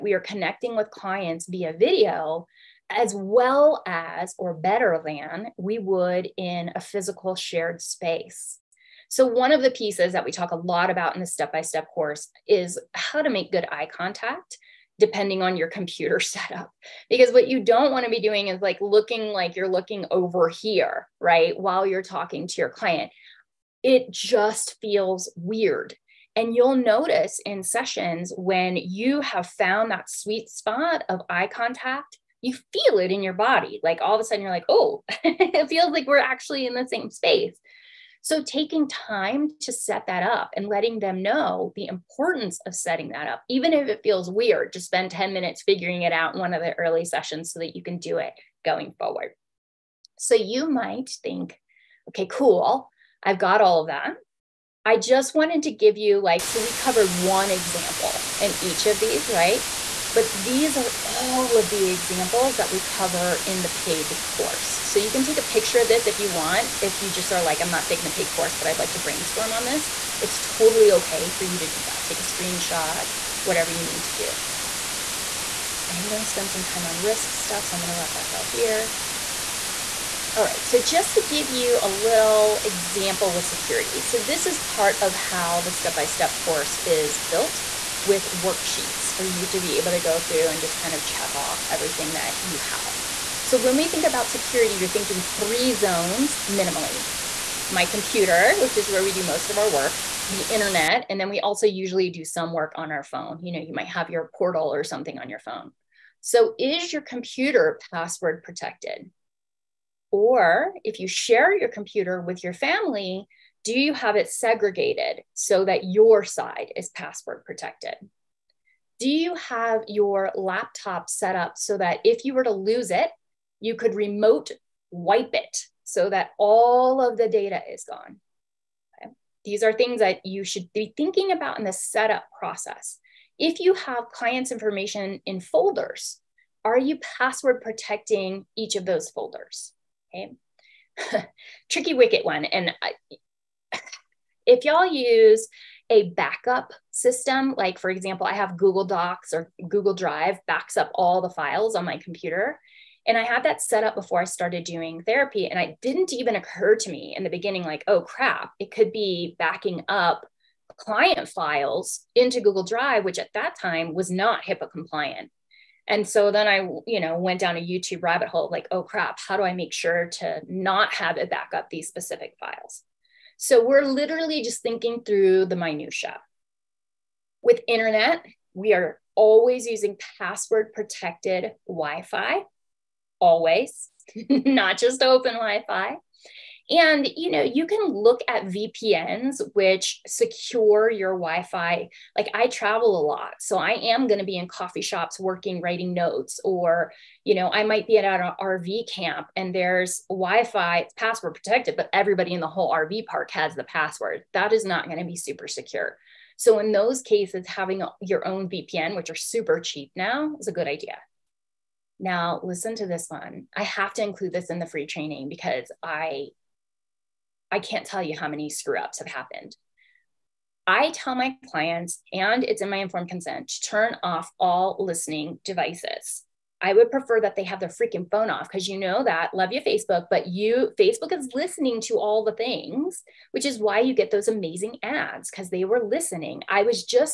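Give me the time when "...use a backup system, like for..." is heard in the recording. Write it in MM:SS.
02:24.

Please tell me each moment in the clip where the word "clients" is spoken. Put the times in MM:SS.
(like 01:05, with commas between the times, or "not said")
00:00, 00:22, 02:14, 02:40, 03:41.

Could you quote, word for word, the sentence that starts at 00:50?
So you might think, okay, cool, I've got all of that.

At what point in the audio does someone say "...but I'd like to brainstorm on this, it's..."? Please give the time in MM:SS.
01:08.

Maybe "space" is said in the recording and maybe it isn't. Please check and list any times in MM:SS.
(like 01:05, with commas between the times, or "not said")
00:07, 00:37.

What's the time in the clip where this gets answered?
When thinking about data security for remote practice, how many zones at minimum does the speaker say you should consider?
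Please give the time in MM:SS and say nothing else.
01:35.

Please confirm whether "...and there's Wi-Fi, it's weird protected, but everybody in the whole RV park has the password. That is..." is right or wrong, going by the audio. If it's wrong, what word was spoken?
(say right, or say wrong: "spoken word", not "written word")
wrong: "password", not "weird".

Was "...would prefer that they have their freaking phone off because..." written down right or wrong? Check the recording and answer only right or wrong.
right.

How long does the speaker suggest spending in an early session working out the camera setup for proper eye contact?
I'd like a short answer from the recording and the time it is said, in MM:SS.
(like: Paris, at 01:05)
10 minutes, at 00:45.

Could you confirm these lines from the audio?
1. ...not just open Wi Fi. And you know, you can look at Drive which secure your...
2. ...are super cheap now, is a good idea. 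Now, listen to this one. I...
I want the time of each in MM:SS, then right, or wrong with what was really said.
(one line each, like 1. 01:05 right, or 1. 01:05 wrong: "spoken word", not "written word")
1. 03:04 wrong: "VPNs", not "Drive"
2. 03:29 right.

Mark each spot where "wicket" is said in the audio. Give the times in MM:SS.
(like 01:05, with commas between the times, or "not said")
02:21.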